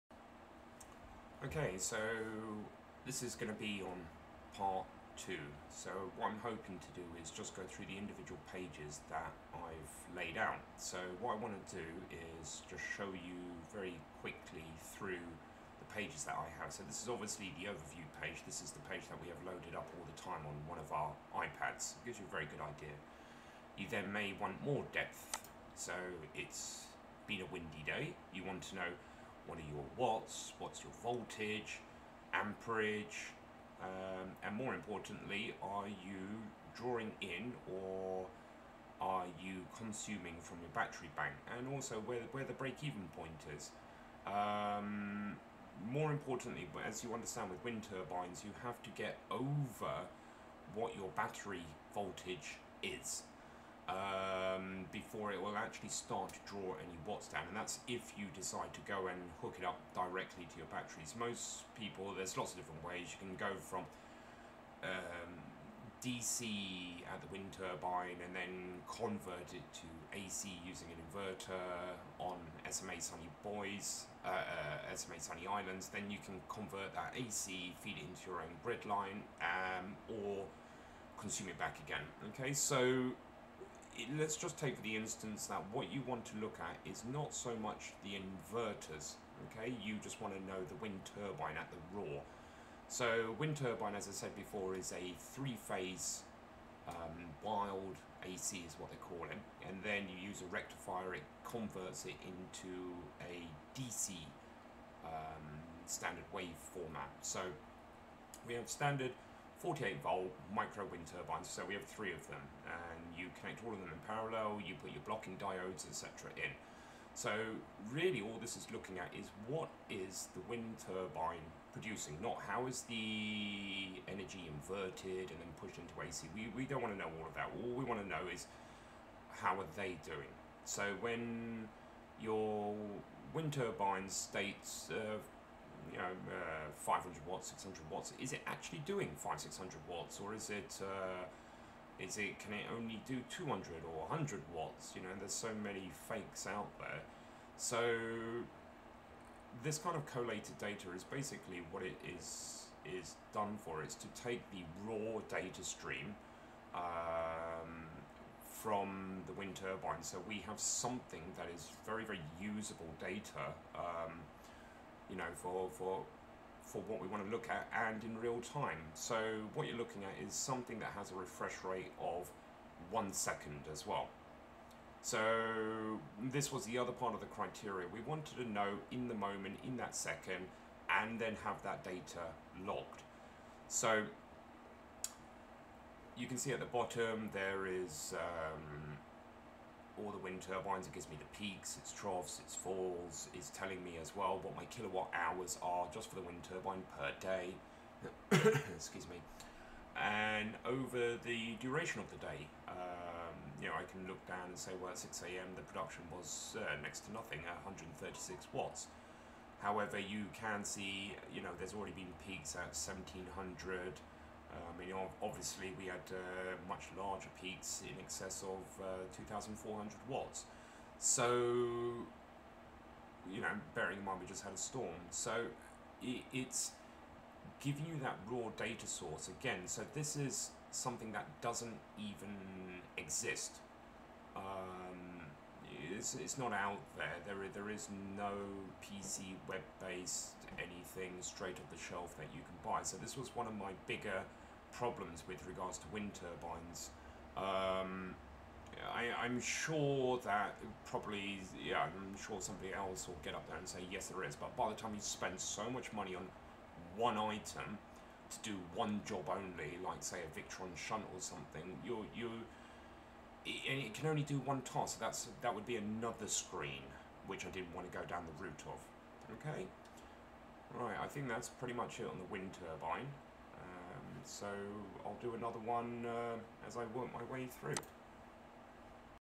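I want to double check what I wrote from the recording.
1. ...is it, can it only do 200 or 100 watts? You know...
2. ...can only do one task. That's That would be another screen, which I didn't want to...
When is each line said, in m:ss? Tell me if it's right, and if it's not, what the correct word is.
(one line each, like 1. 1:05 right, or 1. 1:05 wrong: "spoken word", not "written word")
1. 2:22 right
2. 4:23 right.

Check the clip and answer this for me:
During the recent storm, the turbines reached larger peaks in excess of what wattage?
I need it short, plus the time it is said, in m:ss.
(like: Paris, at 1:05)
2,400 watts, at 3:39.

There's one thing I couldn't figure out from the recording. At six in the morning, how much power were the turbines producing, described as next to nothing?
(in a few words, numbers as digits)
136 watts.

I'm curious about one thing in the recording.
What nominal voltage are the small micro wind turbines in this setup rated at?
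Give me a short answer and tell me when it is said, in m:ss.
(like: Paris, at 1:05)
48 volt, at 1:49.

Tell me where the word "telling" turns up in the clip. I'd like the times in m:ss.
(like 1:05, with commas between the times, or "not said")
3:13.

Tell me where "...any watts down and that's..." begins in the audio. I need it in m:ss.
0:56.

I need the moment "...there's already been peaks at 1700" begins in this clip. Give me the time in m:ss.
3:31.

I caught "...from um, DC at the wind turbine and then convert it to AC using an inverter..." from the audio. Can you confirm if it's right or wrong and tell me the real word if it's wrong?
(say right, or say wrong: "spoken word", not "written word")
right.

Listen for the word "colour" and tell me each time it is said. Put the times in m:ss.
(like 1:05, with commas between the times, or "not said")
not said.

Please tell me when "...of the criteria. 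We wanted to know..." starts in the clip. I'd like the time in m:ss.
2:57.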